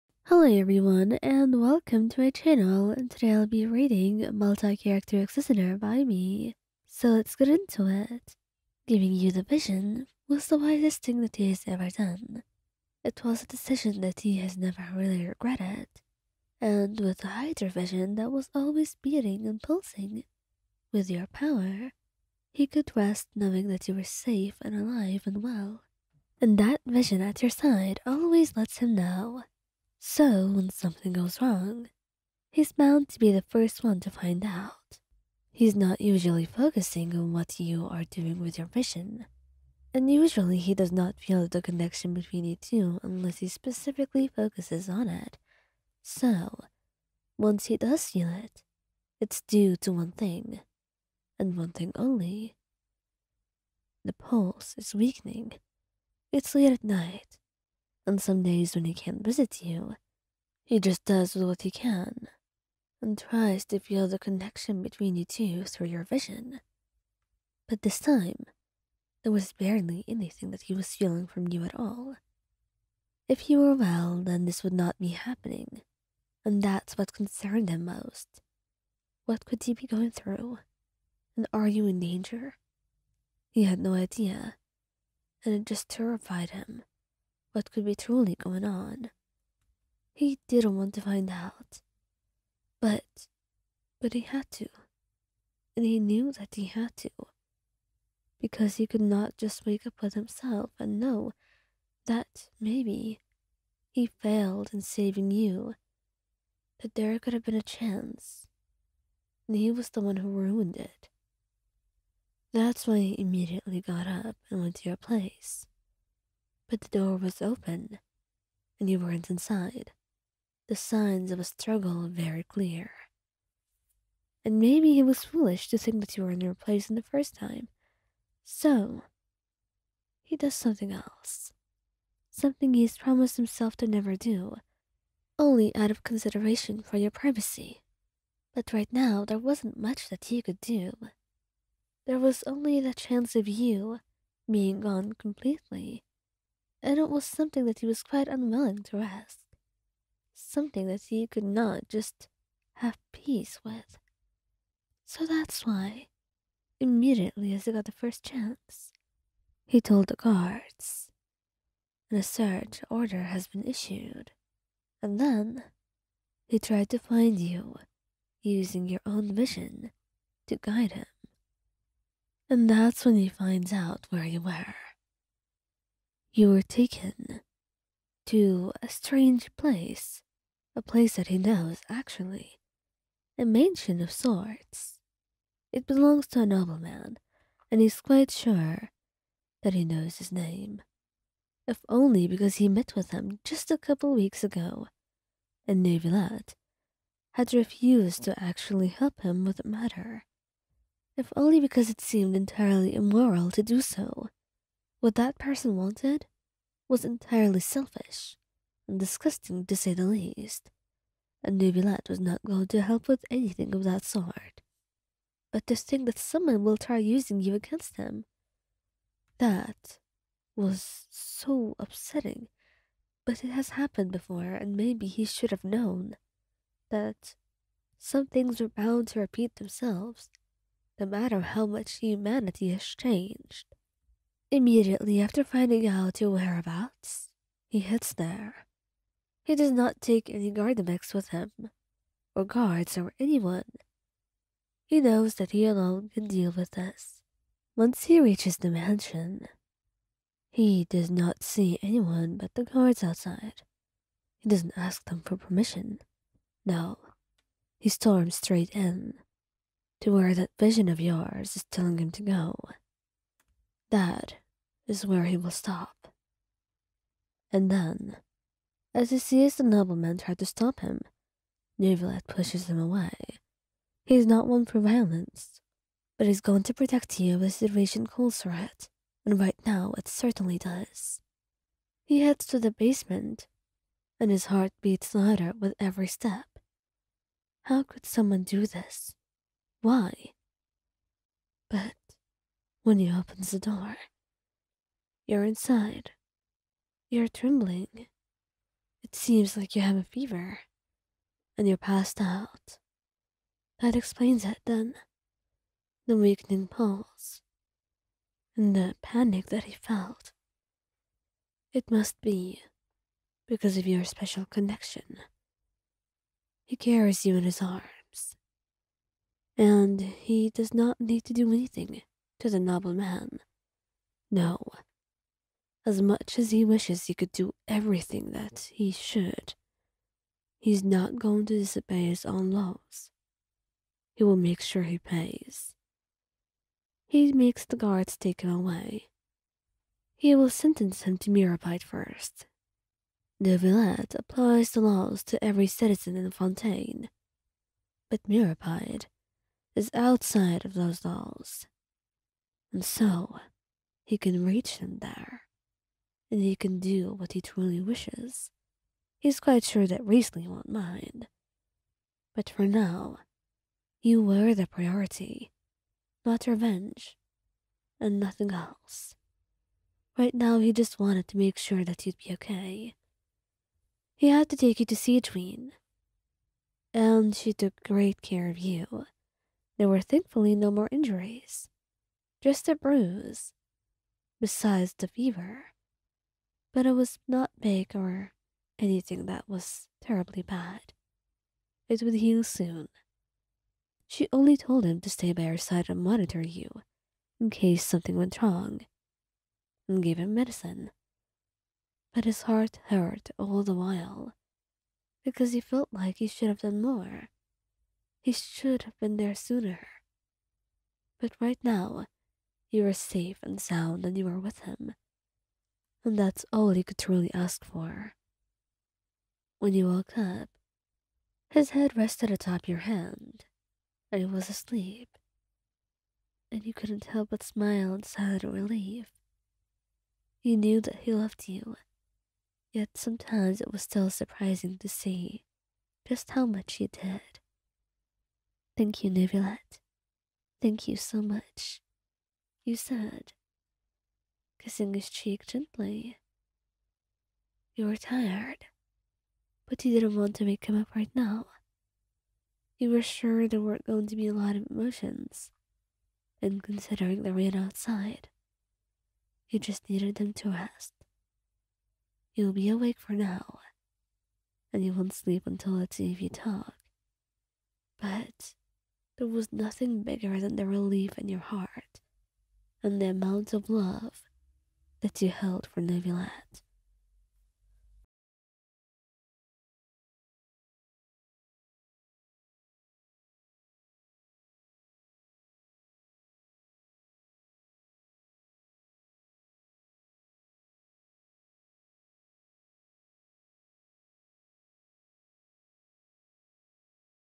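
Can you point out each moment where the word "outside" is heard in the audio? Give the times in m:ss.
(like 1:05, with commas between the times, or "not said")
4:13, 5:49, 7:37.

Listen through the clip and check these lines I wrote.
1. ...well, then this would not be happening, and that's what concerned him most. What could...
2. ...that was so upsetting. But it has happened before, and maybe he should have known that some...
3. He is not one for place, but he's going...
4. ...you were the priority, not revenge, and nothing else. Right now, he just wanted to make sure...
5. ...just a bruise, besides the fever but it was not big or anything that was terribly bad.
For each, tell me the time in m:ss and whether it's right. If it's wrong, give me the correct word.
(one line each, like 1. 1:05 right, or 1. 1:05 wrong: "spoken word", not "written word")
1. 1:13 right
2. 3:39 right
3. 4:34 wrong: "violence", not "place"
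4. 6:04 right
5. 6:22 right.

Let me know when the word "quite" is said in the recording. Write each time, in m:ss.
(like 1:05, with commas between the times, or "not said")
2:28, 3:07, 5:59.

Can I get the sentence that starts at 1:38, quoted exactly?
Because he could not just wake up with himself and know that maybe he failed in saving you.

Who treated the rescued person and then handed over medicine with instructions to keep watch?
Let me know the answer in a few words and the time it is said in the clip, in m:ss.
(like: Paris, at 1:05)
Adrene, at 6:15.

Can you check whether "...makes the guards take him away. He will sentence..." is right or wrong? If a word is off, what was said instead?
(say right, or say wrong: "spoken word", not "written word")
right.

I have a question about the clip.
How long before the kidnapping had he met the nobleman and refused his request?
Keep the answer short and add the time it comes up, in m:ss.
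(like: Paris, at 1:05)
a couple weeks, at 3:13.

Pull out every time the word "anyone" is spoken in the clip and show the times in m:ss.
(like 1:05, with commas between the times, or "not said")
4:03, 4:11.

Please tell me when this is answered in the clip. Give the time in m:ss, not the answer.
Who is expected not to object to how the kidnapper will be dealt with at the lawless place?
6:00.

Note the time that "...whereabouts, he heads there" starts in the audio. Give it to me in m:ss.
3:56.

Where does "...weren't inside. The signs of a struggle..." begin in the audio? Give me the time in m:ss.
1:58.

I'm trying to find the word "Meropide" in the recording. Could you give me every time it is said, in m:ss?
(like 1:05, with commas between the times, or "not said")
5:41, 5:48.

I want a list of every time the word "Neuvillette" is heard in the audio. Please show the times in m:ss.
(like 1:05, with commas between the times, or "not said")
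3:15, 3:31, 4:31, 5:43, 7:19, 7:55.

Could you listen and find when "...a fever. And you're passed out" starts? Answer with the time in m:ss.
4:59.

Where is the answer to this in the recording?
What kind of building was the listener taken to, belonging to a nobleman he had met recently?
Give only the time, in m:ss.
3:03.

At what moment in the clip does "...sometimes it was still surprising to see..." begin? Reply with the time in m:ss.
7:12.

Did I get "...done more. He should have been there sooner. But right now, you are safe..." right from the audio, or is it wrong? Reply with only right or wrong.
right.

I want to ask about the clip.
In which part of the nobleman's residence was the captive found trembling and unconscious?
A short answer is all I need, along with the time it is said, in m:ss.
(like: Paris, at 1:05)
basement, at 4:42.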